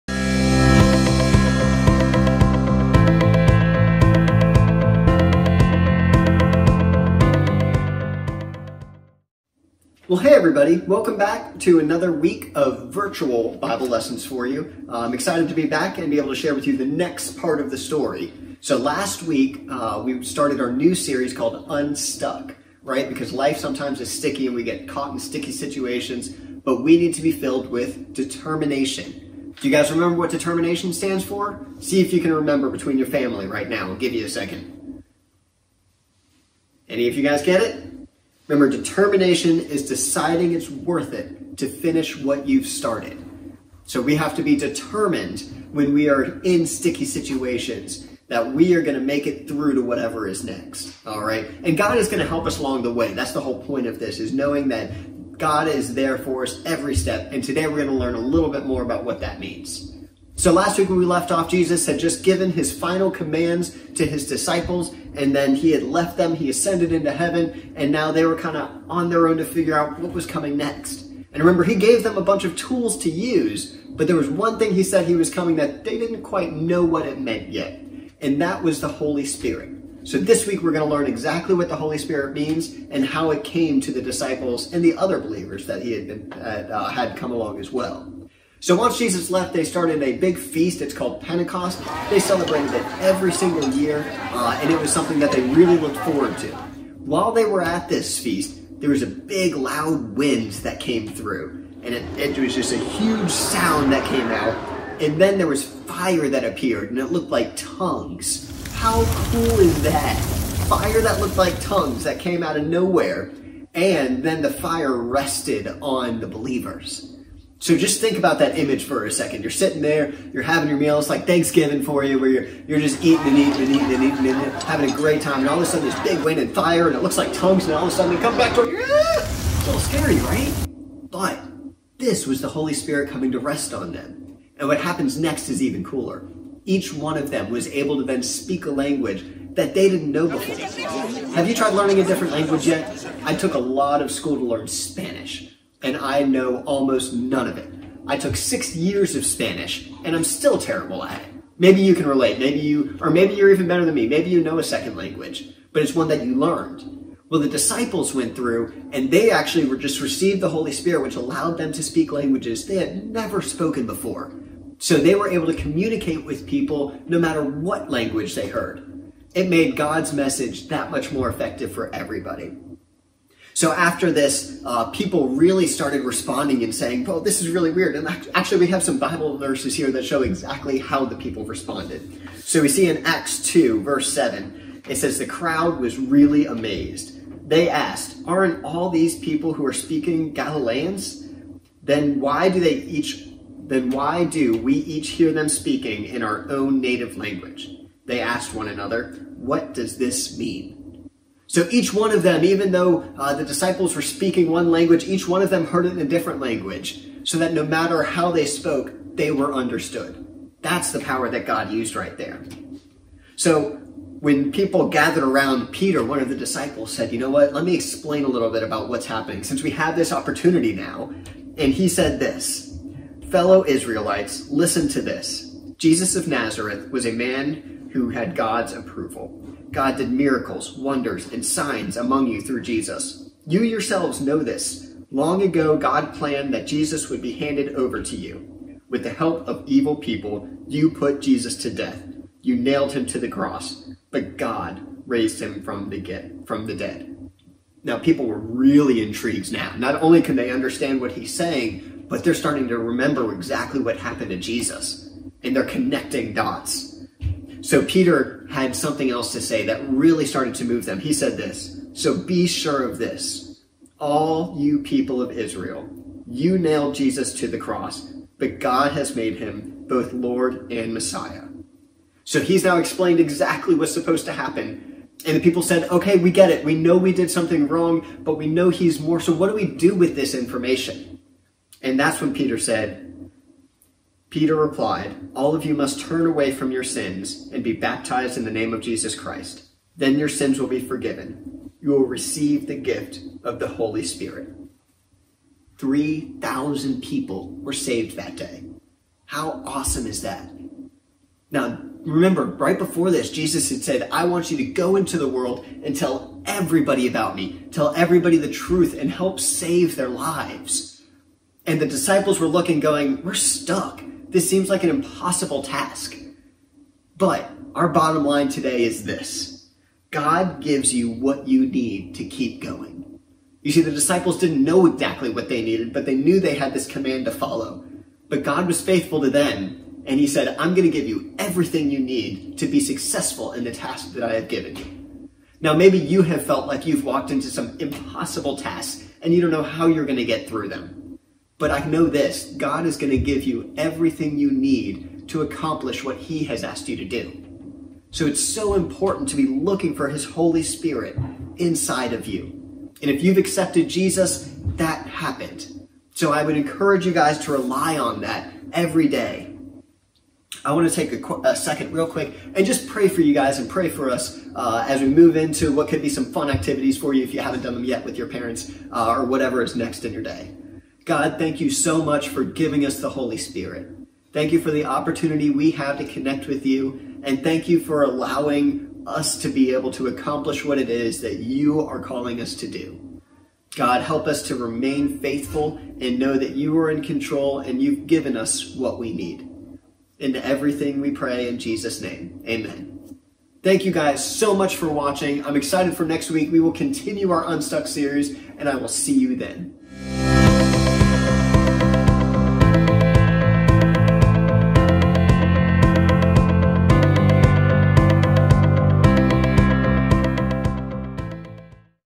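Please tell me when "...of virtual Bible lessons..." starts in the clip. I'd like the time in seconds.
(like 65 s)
12 s.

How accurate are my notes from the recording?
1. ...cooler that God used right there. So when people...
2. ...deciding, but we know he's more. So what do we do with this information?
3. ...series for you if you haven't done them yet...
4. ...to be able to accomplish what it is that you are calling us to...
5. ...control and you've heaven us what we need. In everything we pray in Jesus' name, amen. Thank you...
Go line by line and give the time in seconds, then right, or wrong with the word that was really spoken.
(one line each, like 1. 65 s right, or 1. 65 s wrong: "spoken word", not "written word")
1. 211 s wrong: "power", not "cooler"
2. 277 s wrong: "wrong", not "deciding"
3. 366 s wrong: "activities", not "series"
4. 379 s right
5. 387 s wrong: "given", not "heaven".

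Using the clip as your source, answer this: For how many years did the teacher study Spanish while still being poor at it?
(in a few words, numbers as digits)
6.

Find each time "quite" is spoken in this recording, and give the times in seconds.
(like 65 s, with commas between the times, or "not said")
76 s.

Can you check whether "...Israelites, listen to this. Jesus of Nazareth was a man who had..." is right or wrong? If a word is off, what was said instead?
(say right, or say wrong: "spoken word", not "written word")
right.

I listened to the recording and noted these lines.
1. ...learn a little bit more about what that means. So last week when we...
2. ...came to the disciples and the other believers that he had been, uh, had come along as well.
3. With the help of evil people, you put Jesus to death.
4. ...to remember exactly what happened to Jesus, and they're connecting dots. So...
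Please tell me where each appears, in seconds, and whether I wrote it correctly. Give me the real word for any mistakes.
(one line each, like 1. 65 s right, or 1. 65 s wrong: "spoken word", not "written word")
1. 57 s right
2. 83 s right
3. 238 s right
4. 252 s right.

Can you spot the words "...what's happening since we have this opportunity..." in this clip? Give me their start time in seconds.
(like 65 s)
218 s.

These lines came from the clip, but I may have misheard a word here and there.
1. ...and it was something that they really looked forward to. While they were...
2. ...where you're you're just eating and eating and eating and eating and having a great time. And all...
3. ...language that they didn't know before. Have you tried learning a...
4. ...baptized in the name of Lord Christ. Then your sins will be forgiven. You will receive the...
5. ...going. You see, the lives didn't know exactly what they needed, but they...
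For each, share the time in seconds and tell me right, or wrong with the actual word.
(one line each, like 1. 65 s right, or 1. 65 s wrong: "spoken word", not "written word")
1. 94 s right
2. 122 s right
3. 138 s right
4. 287 s wrong: "Jesus", not "Lord"
5. 322 s wrong: "disciples", not "lives".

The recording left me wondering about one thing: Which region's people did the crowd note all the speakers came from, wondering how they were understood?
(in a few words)
Galileans.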